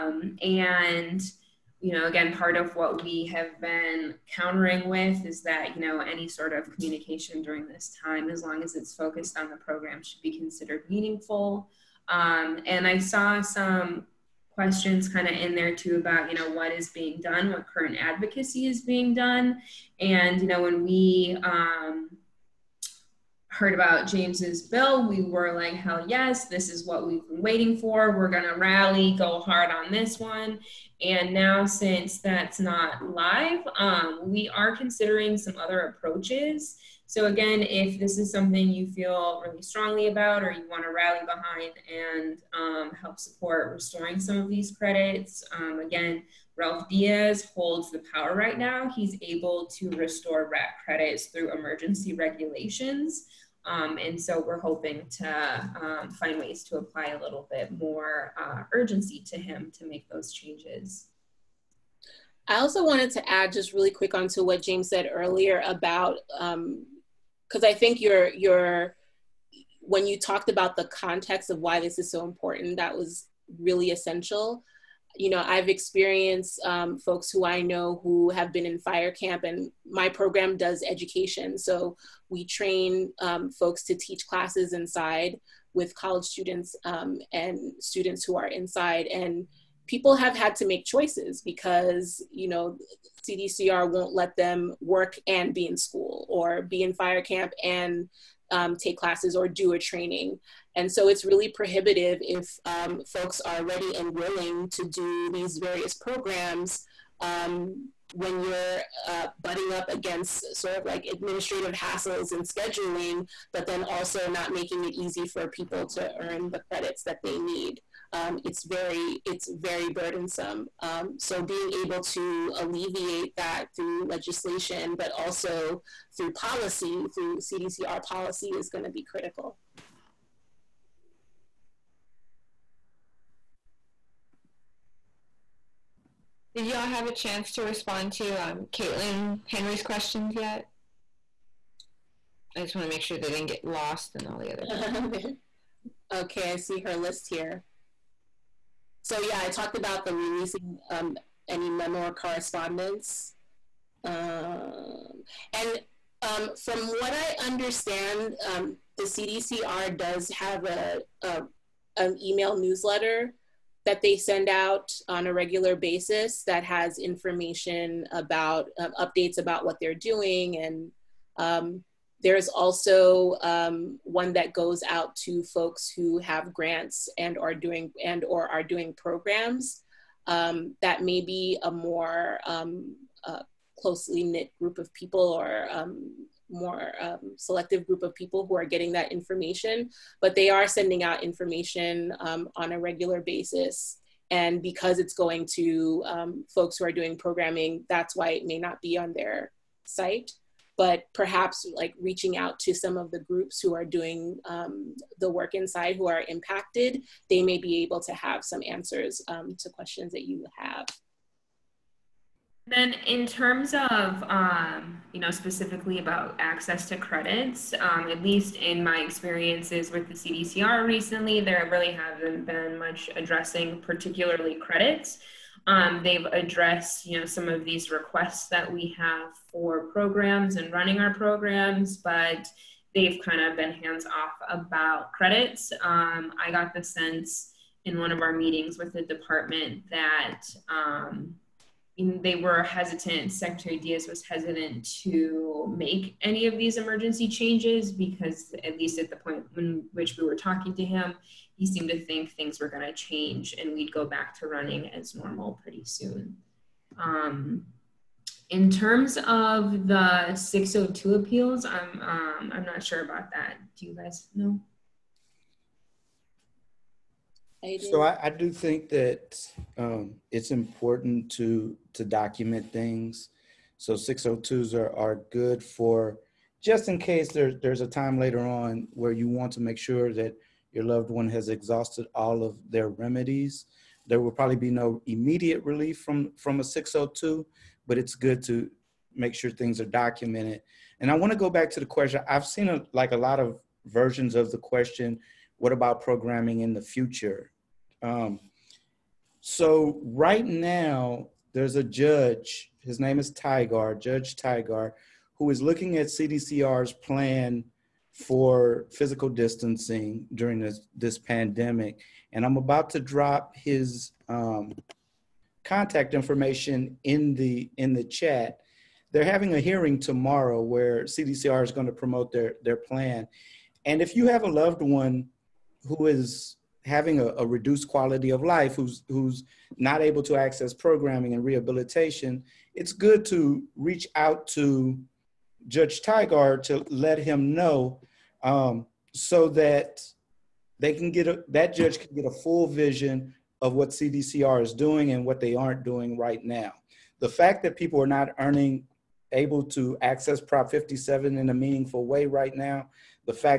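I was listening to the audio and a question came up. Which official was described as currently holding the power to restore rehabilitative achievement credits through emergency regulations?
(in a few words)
Ralph Diaz.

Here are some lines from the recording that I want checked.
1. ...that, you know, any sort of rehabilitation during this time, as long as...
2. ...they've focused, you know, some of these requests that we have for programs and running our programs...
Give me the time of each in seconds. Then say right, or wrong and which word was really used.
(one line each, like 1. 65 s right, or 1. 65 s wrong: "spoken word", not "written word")
1. 5 s wrong: "communication", not "rehabilitation"
2. 226 s wrong: "addressed", not "focused".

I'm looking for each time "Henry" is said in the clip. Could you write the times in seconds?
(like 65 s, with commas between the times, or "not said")
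139 s.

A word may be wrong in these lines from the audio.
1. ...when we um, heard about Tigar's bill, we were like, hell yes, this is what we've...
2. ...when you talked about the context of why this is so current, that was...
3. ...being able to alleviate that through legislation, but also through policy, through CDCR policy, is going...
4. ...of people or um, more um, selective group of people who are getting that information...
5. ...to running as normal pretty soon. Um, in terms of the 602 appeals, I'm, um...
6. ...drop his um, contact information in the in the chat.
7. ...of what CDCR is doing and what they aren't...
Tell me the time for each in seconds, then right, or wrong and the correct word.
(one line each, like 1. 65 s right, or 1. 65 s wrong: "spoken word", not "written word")
1. 20 s wrong: "James", not "Tigar"
2. 69 s wrong: "important", not "current"
3. 121 s right
4. 184 s right
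5. 254 s right
6. 313 s right
7. 343 s right.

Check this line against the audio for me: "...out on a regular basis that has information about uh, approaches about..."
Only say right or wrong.
wrong.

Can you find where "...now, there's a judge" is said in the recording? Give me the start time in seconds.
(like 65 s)
300 s.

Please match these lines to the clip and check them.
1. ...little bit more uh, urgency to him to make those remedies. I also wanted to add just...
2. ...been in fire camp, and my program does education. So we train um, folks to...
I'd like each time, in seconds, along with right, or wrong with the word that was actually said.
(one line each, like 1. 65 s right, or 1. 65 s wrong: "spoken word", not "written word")
1. 57 s wrong: "changes", not "remedies"
2. 78 s right.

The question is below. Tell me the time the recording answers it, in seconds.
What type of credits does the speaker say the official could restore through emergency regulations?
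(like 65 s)
50 s.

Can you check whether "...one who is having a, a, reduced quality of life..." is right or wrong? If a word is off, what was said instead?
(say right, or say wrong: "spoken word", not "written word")
right.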